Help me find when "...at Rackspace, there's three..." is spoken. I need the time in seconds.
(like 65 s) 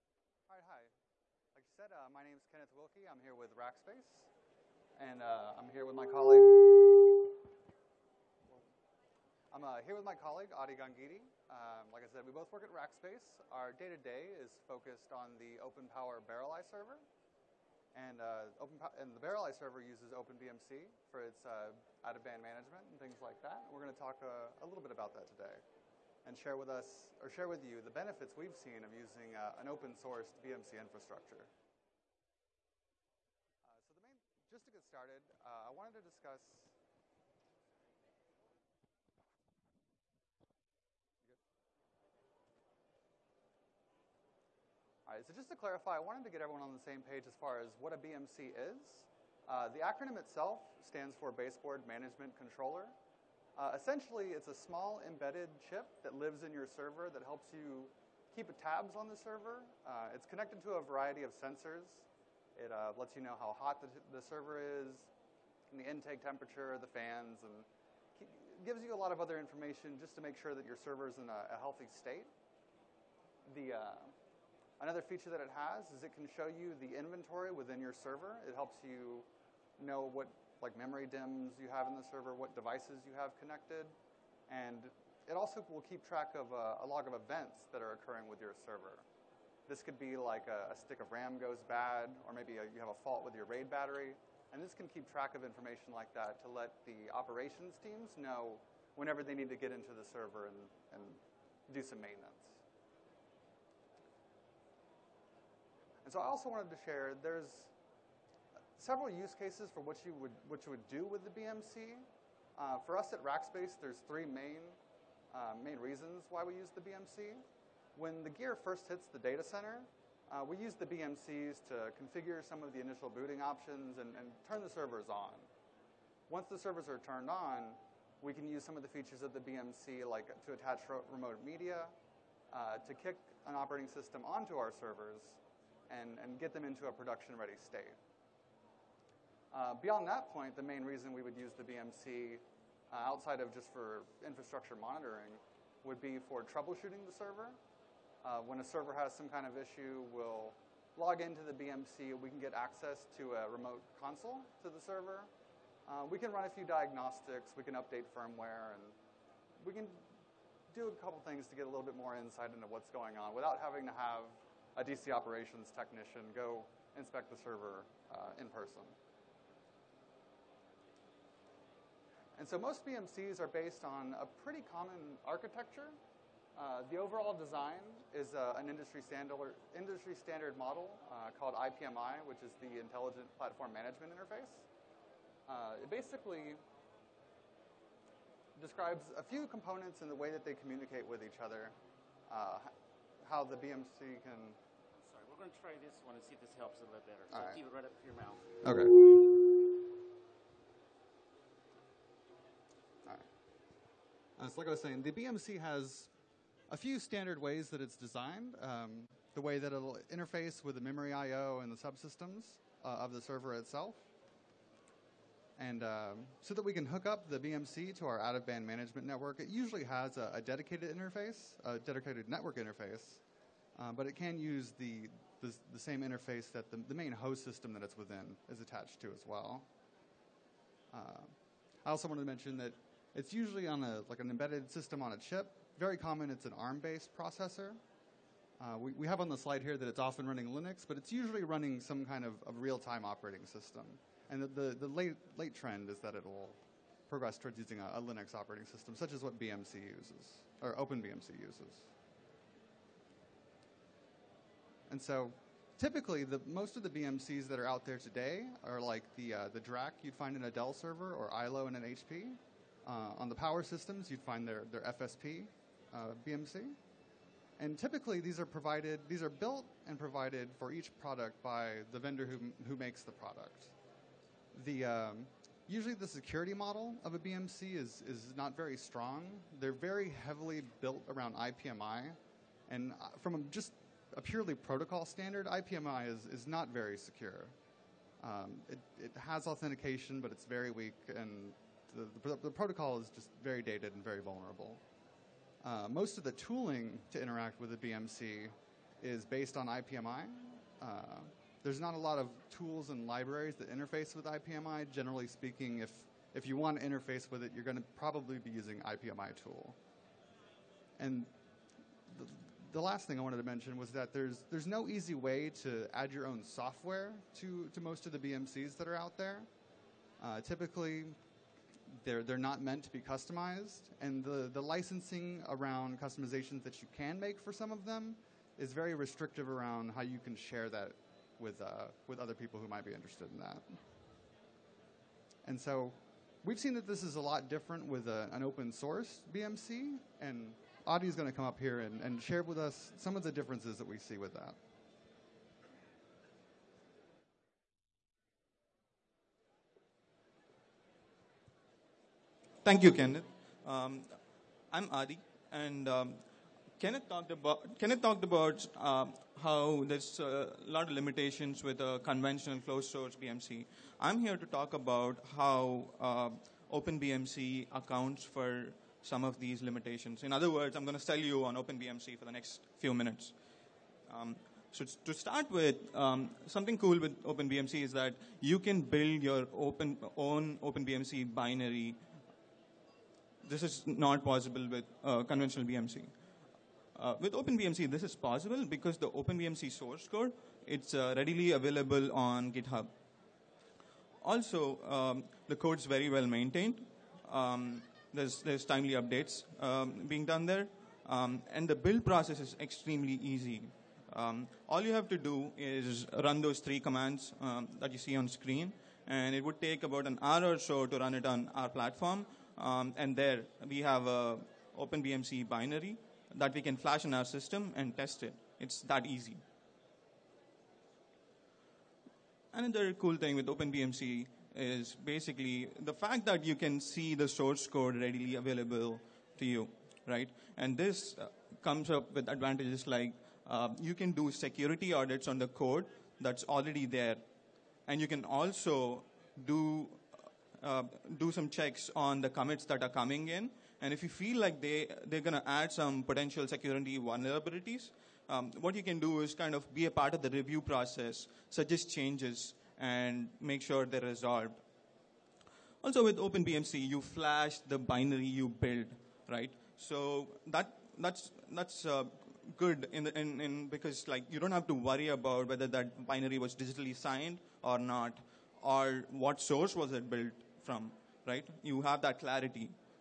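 113 s.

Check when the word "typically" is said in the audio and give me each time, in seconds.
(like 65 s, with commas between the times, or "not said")
255 s, 267 s, 320 s.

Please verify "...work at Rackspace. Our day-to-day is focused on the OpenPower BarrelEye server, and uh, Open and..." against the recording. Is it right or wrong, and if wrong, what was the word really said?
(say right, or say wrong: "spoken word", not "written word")
right.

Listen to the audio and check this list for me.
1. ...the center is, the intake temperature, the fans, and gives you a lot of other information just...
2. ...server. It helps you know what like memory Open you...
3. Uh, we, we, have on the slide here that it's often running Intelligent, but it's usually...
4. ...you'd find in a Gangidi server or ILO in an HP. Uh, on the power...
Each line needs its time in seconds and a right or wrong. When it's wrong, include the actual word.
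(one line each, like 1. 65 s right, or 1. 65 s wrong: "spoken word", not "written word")
1. 64 s wrong: "server", not "center"
2. 77 s wrong: "DIMMs", not "Open"
3. 238 s wrong: "Linux", not "Intelligent"
4. 260 s wrong: "Dell", not "Gangidi".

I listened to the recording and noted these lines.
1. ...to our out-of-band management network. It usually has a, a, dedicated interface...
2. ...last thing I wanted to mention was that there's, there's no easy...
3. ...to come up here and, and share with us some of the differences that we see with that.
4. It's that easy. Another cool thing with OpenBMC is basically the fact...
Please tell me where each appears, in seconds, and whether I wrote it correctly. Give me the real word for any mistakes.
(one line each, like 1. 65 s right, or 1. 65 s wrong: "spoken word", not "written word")
1. 217 s right
2. 312 s right
3. 341 s right
4. 418 s right.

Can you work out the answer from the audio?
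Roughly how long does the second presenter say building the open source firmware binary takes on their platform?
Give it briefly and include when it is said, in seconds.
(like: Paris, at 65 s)
about an hour, at 409 s.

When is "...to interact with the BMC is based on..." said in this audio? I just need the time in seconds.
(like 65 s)
297 s.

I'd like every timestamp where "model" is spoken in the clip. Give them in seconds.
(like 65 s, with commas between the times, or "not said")
180 s, 276 s.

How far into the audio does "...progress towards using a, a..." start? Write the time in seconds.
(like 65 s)
247 s.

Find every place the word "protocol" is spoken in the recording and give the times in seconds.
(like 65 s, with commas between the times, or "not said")
284 s, 292 s.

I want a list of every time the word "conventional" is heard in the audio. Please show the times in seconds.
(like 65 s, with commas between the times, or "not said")
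362 s, 385 s.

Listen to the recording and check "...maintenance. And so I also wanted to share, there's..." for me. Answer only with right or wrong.
right.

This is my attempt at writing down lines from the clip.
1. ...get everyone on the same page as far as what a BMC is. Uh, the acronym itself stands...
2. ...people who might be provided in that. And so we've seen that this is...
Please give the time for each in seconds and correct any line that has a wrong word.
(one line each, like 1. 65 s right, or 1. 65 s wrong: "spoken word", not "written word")
1. 46 s right
2. 332 s wrong: "interested", not "provided".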